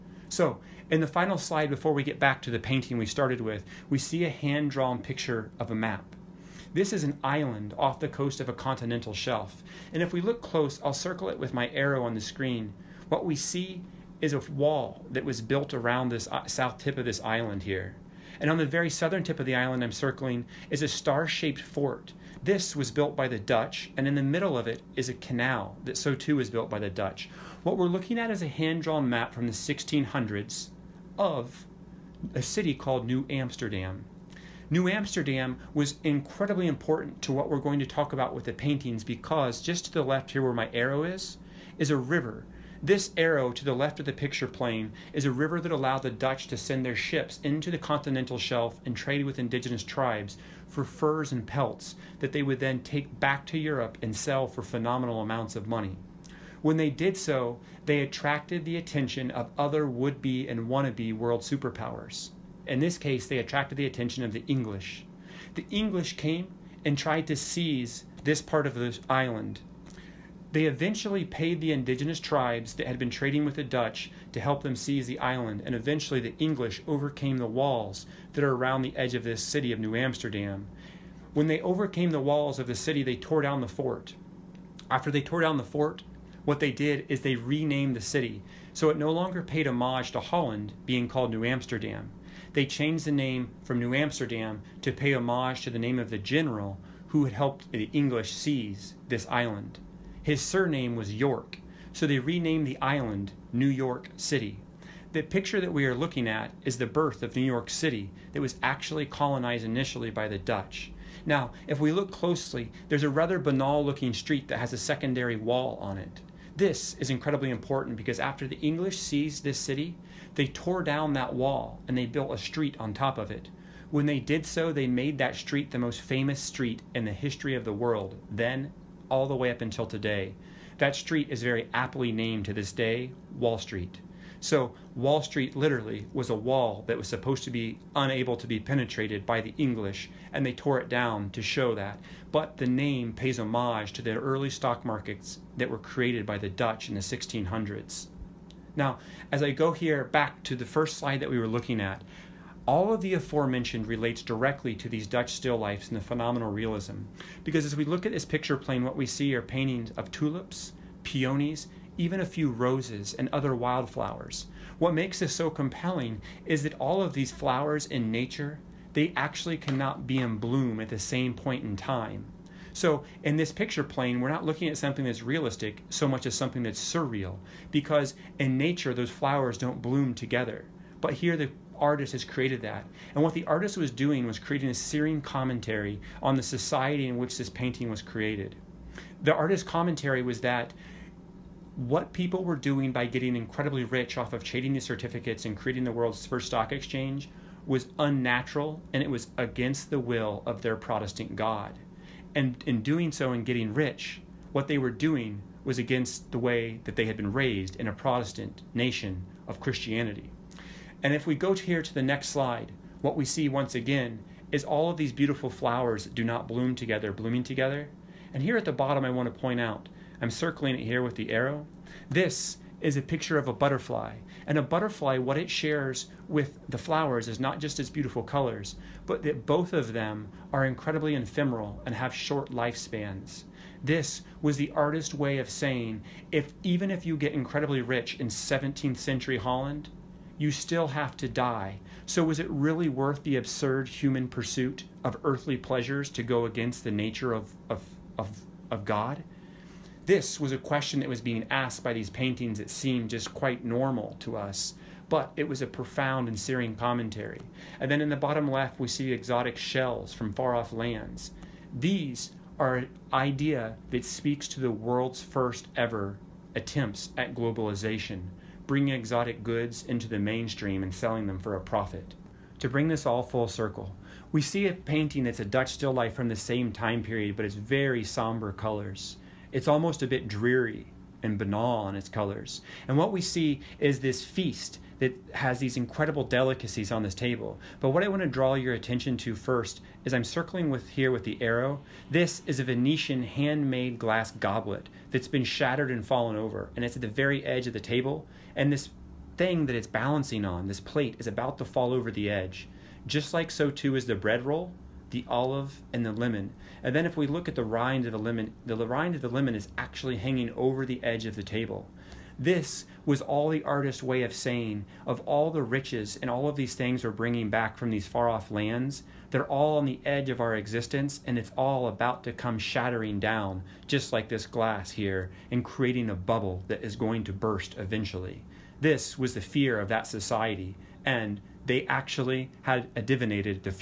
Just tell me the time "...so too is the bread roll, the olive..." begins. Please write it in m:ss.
5:03.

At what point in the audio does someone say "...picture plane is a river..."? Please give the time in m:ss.
0:44.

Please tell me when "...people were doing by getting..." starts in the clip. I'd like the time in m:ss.
3:12.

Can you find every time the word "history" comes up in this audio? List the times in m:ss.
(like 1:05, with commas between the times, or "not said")
2:07.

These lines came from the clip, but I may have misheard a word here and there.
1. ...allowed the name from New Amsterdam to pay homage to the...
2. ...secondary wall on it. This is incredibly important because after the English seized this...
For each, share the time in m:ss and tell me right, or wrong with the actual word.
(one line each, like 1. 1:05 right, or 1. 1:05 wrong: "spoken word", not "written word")
1. 1:32 wrong: "changed", not "allowed"
2. 1:54 right.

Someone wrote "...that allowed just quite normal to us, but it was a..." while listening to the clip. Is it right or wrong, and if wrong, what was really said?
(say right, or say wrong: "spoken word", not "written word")
wrong: "seemed", not "allowed".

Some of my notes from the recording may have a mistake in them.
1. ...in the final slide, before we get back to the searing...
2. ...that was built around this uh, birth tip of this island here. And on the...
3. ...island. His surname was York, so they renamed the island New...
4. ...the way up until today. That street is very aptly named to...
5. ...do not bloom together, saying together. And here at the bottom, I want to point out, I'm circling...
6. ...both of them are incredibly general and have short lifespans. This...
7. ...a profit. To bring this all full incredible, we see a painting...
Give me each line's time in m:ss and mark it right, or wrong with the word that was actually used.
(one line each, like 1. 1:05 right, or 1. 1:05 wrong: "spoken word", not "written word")
1. 0:00 wrong: "painting", not "searing"
2. 0:15 wrong: "south", not "birth"
3. 1:39 right
4. 2:09 right
5. 3:36 wrong: "blooming", not "saying"
6. 3:49 wrong: "ephemeral", not "general"
7. 4:31 wrong: "circle", not "incredible".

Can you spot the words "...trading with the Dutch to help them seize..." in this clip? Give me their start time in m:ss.
1:13.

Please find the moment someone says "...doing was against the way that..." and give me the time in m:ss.
3:24.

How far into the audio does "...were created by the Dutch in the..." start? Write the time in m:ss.
2:25.